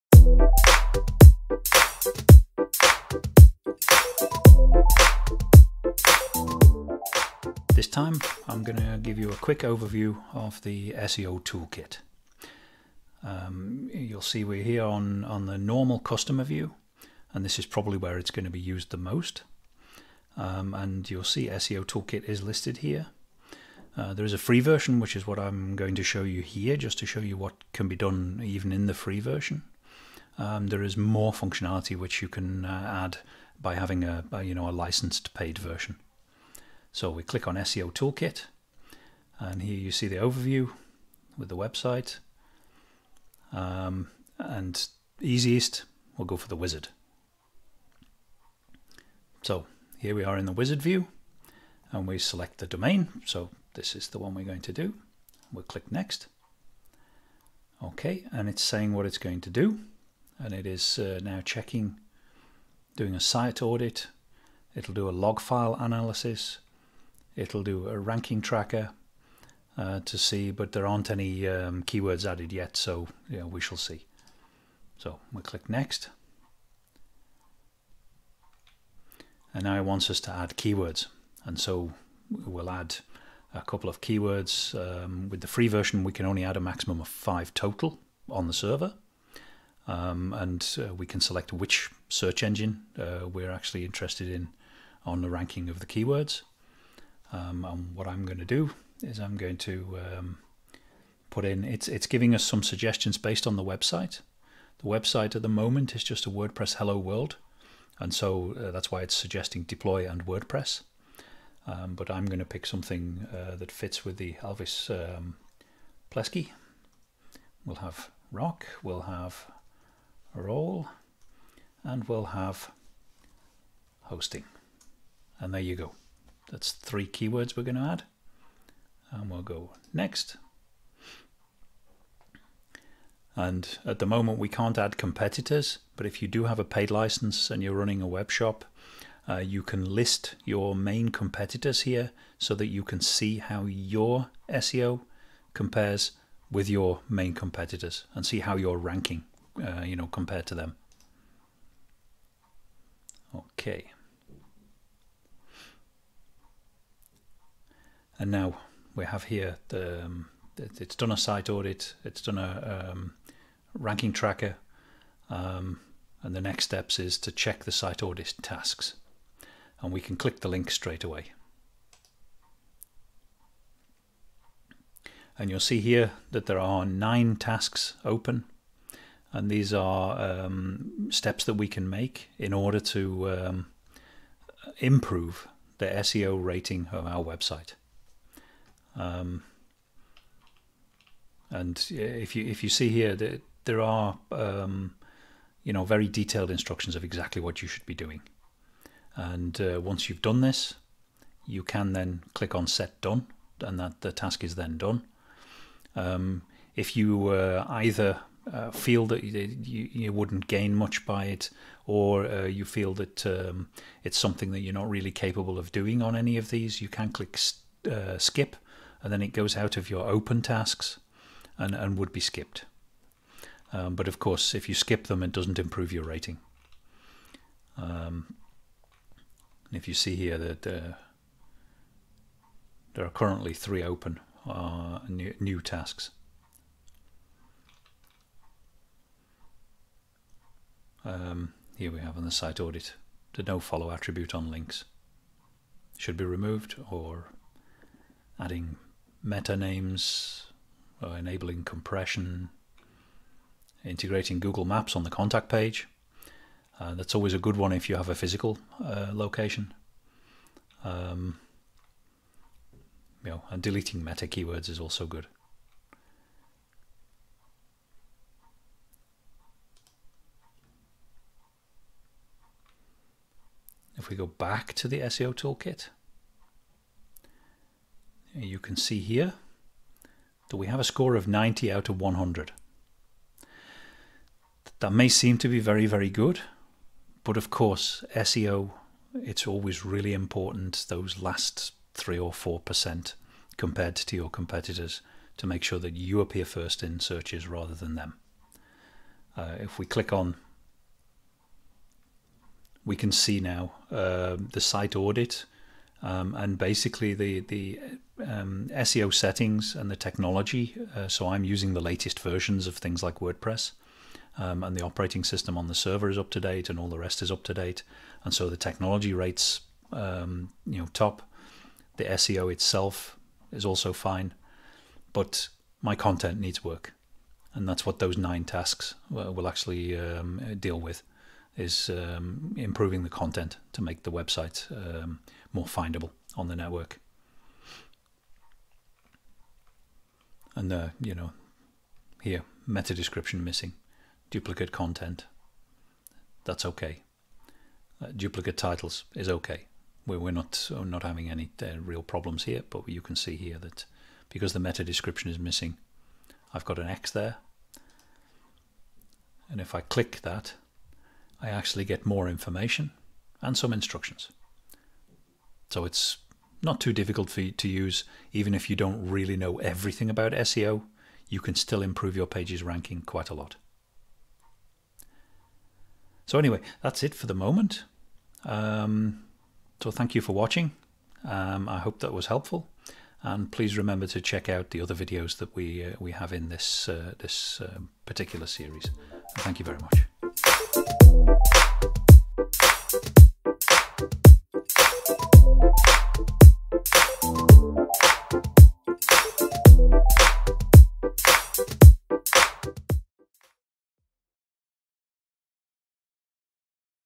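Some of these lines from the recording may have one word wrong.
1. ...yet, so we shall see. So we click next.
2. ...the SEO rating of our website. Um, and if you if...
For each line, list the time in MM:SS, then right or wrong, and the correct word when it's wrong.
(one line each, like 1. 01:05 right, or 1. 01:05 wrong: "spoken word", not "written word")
1. 01:12 right
2. 03:05 right.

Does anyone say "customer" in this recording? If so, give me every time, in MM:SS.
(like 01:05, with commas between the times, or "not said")
00:15.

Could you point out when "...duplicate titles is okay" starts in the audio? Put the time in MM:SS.
05:48.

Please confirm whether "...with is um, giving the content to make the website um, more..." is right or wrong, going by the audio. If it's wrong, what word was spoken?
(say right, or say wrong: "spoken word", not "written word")
wrong: "improving", not "giving".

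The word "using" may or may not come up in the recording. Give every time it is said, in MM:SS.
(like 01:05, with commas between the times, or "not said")
05:11.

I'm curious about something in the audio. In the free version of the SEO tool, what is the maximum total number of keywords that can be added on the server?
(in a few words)
5.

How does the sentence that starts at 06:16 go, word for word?
So anyway, that's it for the moment.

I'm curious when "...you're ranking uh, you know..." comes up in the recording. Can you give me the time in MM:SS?
02:28.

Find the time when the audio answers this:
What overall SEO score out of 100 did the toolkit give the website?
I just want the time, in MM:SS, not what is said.
04:41.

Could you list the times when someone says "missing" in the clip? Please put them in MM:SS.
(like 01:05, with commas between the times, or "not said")
05:43, 05:55.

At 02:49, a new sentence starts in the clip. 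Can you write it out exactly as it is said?
And we can click the link straight away.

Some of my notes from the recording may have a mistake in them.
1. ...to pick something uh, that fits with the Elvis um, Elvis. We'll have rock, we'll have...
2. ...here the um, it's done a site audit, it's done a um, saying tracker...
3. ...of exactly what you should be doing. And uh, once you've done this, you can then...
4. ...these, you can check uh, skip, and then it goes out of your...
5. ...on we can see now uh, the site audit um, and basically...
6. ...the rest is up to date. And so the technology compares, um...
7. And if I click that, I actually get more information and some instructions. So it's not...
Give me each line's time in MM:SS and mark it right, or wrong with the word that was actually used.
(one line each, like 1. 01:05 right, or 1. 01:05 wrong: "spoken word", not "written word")
1. 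01:52 wrong: "Plesky", not "Elvis"
2. 02:39 wrong: "ranking", not "saying"
3. 03:16 right
4. 03:36 wrong: "click", not "check"
5. 05:00 right
6. 05:16 wrong: "rates", not "compares"
7. 05:59 right.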